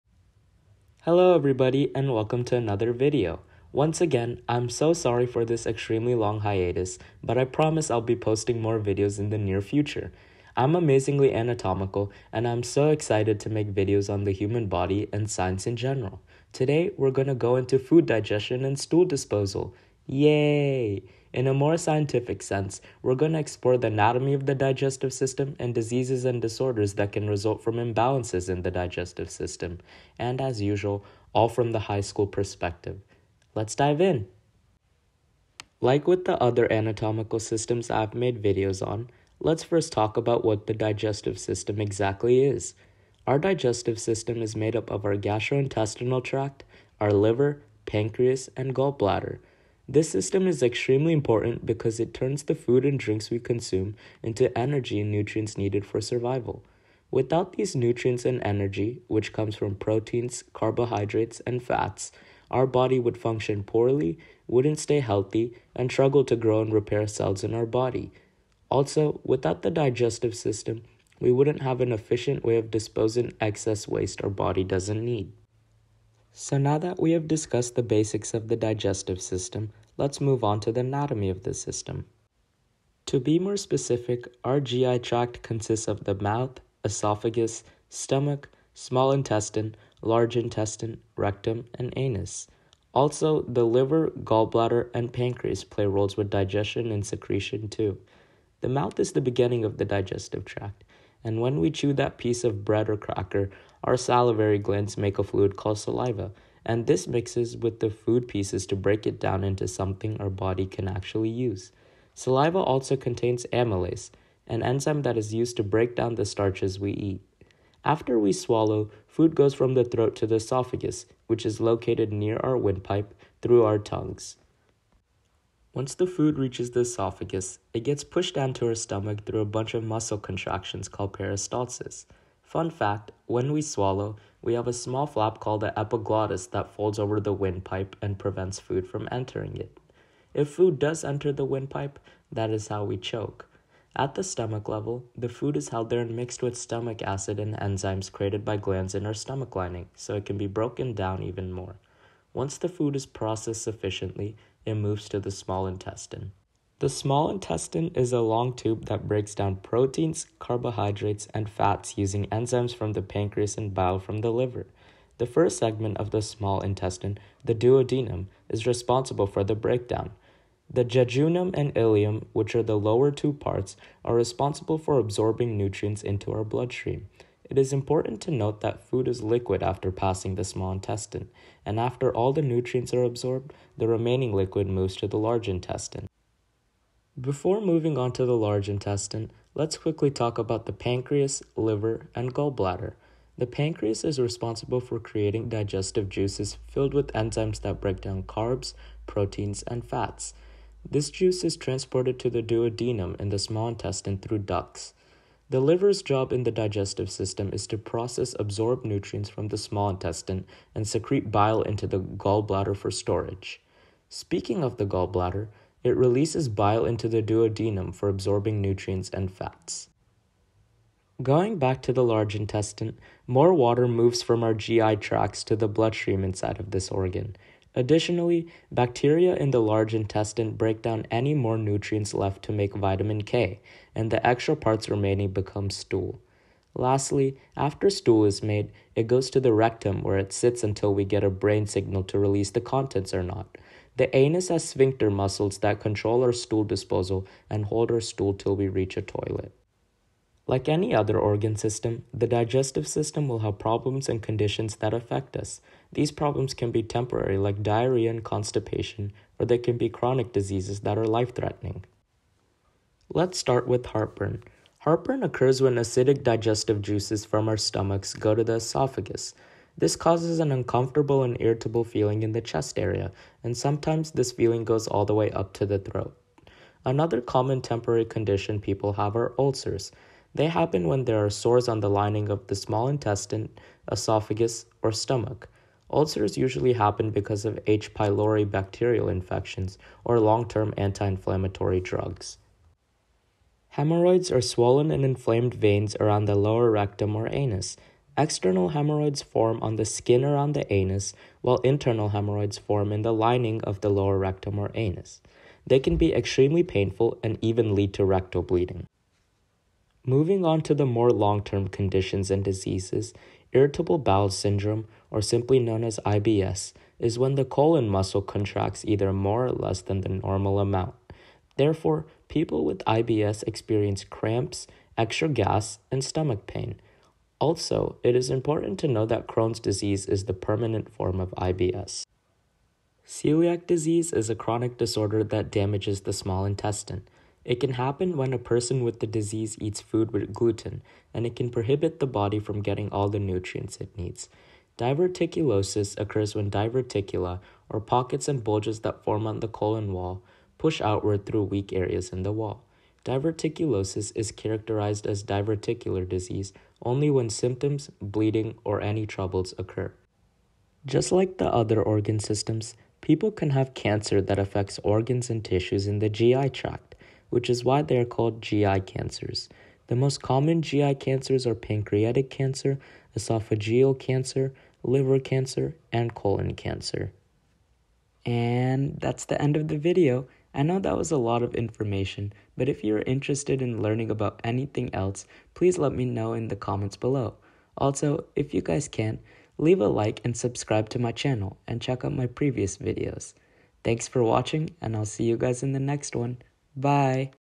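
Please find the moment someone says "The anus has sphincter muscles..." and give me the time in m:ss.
4:03.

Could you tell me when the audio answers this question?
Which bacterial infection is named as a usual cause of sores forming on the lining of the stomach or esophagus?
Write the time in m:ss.
4:47.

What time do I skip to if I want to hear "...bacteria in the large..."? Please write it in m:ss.
3:48.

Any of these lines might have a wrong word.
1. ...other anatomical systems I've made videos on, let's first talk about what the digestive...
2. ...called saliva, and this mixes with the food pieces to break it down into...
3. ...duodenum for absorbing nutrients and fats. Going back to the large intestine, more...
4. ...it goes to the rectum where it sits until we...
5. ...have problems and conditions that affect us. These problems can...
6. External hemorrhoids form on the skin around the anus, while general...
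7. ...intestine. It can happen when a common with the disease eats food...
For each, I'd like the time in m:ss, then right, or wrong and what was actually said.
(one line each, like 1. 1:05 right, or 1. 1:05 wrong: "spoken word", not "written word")
1. 0:36 right
2. 1:45 right
3. 3:37 right
4. 3:58 right
5. 4:13 right
6. 4:58 wrong: "internal", not "general"
7. 5:36 wrong: "person", not "common".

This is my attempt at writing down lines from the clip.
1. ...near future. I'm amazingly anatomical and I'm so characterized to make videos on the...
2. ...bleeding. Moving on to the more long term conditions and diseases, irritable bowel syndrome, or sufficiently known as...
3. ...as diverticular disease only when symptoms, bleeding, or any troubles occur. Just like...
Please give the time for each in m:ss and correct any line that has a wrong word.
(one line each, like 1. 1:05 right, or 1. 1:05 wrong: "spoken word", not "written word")
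1. 0:09 wrong: "excited", not "characterized"
2. 5:08 wrong: "simply", not "sufficiently"
3. 5:55 right.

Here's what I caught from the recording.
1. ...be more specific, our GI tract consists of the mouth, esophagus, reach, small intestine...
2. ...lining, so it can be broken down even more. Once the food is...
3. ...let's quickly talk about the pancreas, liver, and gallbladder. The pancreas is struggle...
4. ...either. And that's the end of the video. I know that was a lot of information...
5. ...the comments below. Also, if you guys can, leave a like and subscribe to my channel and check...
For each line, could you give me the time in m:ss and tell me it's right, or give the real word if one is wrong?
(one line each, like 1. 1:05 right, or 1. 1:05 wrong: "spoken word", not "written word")
1. 1:23 wrong: "stomach", not "reach"
2. 2:29 right
3. 3:09 wrong: "responsible", not "struggle"
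4. 6:16 wrong: "cancer", not "either"
5. 6:26 right.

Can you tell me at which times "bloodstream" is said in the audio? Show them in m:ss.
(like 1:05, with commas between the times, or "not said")
2:56, 3:45.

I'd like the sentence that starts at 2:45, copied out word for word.
The first segment of the small intestine, the duodenum, is responsible for the breakdown.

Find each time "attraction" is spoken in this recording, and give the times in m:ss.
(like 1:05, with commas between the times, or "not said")
not said.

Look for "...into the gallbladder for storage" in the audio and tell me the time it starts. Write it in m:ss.
3:31.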